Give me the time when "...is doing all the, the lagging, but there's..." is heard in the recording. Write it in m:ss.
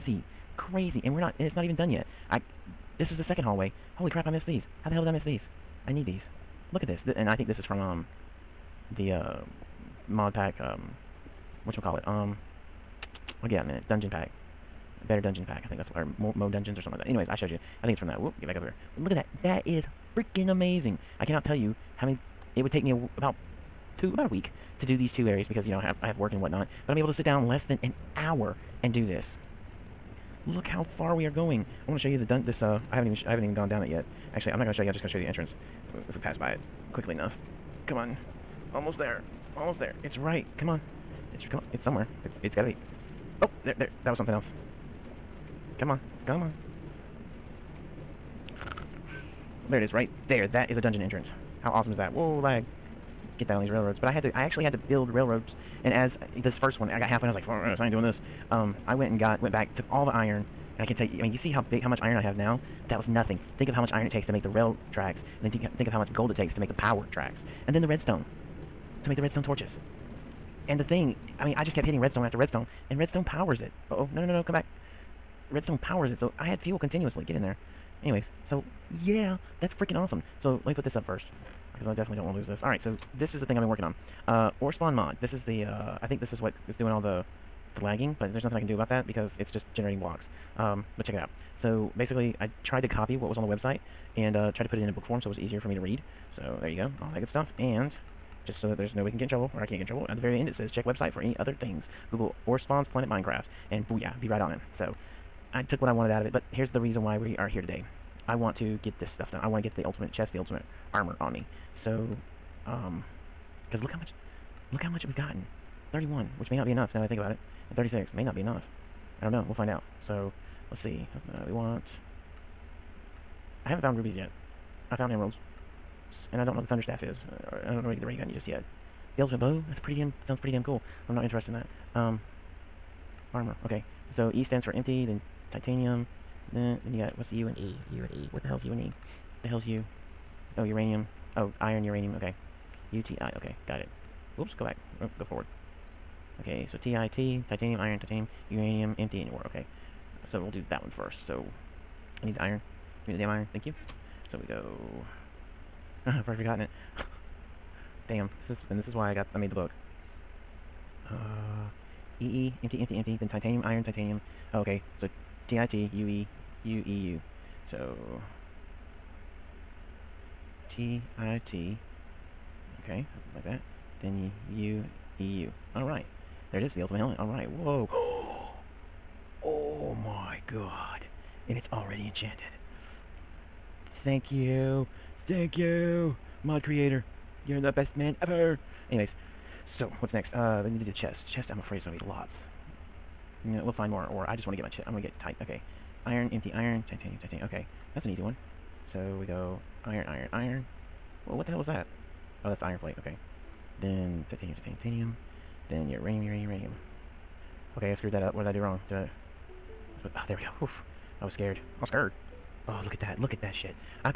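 1:26.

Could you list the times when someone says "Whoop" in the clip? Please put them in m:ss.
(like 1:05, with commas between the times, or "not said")
0:18, 2:24.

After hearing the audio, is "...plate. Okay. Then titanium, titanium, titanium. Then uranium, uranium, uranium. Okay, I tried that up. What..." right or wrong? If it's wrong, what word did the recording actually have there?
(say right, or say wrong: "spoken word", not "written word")
wrong: "screwed", not "tried".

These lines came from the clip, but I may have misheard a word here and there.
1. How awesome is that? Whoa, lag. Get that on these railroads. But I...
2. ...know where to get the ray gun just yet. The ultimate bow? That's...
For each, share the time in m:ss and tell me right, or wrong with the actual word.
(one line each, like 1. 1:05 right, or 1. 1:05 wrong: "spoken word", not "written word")
1. 0:51 right
2. 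2:07 right.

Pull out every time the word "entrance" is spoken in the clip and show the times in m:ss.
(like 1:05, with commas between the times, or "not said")
0:35, 0:51.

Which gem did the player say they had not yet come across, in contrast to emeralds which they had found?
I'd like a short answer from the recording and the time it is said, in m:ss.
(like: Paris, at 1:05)
Rubies, at 2:03.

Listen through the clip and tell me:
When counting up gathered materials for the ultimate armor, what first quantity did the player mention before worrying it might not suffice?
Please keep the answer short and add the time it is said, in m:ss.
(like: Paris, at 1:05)
31, at 1:55.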